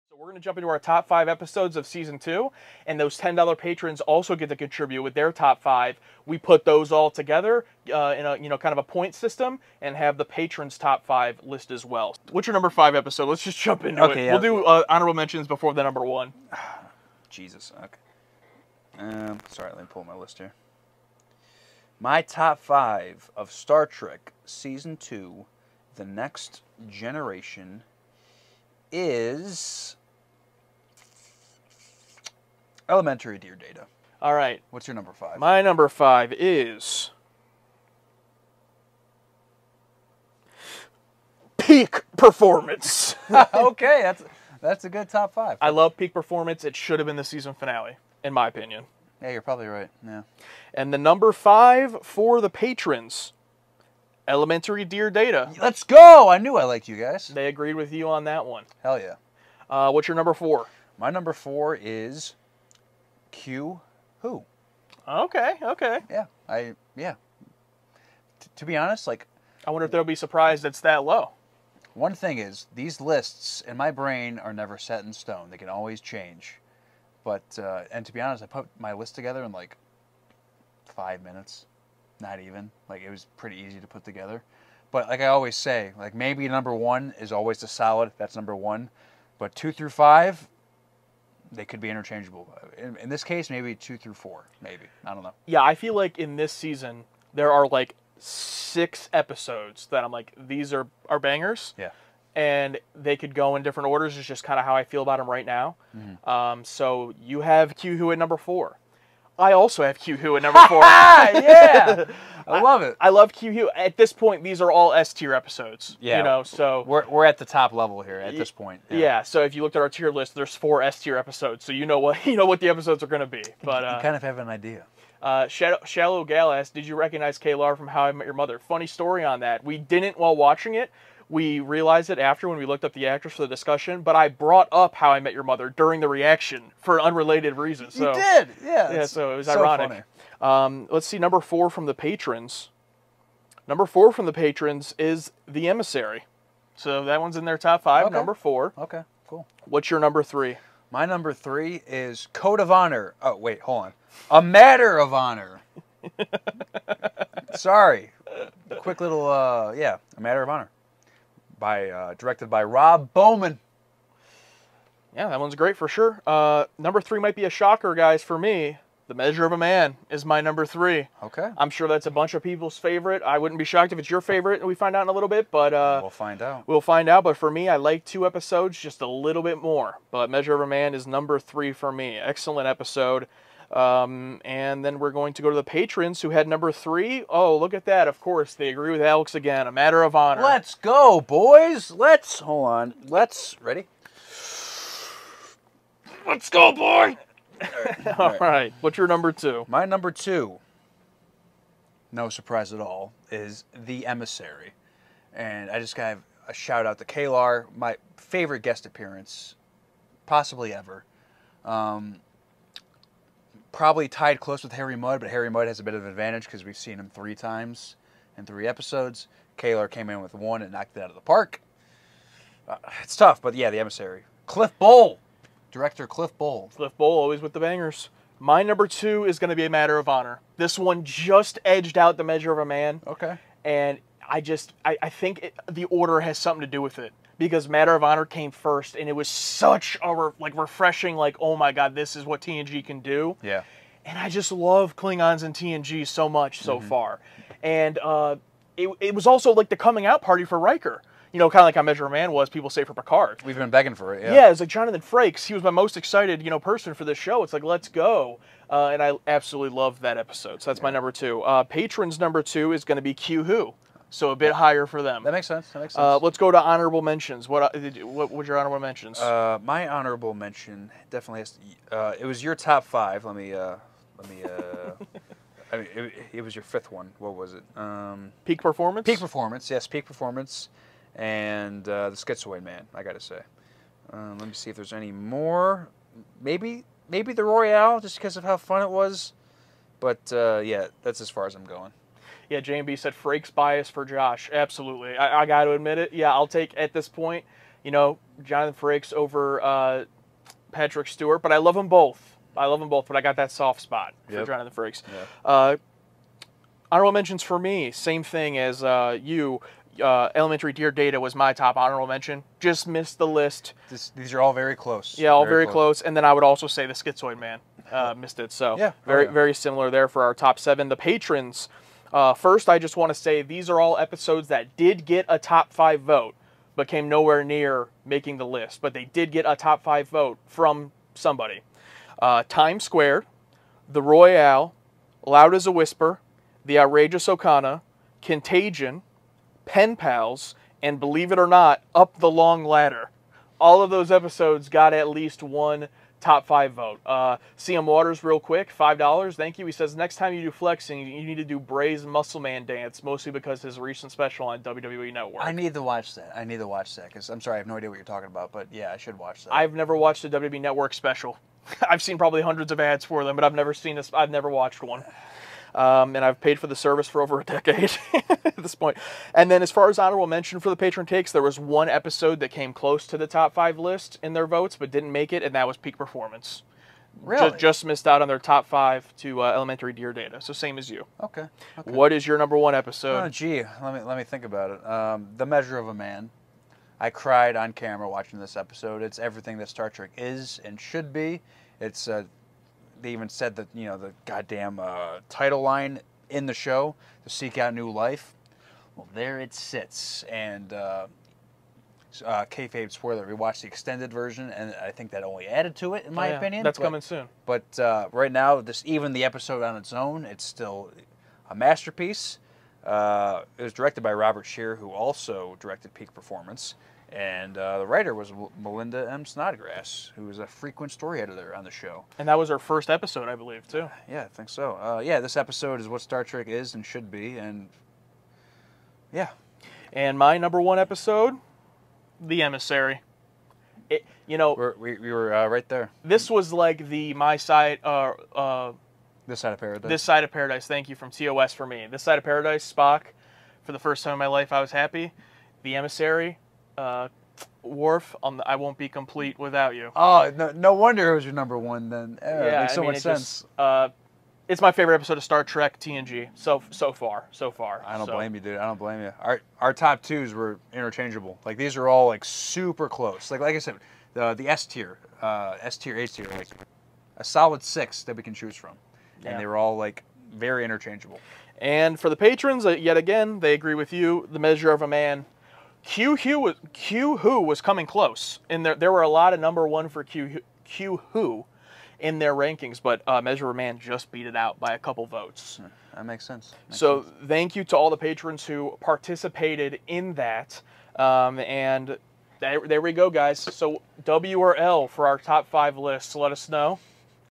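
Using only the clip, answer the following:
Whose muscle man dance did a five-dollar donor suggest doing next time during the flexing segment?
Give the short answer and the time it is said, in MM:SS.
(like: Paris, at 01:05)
Bray, at 05:51.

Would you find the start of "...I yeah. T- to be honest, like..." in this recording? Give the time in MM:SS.
01:06.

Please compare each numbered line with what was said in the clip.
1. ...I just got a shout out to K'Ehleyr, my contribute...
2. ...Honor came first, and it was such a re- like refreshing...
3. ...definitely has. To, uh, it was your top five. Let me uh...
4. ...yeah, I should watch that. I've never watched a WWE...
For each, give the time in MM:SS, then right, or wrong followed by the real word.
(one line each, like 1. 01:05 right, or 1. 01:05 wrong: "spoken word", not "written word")
1. 03:25 wrong: "favorite", not "contribute"
2. 03:58 right
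3. 04:31 right
4. 05:58 right.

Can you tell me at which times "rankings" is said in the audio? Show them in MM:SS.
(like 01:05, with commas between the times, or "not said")
08:02.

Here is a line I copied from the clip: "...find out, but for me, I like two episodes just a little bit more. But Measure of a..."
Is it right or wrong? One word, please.
right.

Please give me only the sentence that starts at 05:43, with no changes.
All of those episodes got at least one top five vote.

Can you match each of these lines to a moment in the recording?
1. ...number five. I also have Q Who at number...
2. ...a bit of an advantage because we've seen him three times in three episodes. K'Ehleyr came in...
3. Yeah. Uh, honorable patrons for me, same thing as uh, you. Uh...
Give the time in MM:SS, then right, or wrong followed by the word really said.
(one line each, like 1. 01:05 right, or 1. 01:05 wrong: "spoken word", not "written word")
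1. 01:48 wrong: "four", not "five"
2. 03:35 right
3. 05:05 wrong: "mentions", not "patrons".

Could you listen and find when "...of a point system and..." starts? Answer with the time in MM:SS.
00:08.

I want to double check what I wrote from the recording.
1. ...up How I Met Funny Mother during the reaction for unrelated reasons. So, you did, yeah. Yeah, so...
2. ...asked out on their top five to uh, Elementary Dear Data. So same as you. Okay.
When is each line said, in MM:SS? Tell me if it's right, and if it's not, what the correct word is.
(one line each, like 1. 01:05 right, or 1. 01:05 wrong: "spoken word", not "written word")
1. 02:14 wrong: "Your", not "Funny"
2. 06:17 wrong: "missed", not "asked".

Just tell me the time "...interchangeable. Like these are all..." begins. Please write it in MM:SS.
07:40.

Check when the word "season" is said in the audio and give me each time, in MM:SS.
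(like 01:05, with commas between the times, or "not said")
00:01, 00:24, 00:47, 01:36.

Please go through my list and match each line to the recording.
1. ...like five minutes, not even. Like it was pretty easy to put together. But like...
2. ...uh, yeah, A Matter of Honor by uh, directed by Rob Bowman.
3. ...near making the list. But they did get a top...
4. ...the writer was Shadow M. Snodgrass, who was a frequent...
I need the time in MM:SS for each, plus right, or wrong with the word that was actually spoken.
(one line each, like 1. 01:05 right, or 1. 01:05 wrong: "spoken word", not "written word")
1. 01:19 right
2. 02:39 right
3. 05:27 right
4. 06:57 wrong: "Melinda", not "Shadow".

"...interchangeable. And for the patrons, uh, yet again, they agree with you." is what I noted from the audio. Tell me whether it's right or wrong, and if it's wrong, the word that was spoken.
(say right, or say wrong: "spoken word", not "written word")
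right.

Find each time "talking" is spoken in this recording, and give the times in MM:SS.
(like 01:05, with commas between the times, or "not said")
05:58.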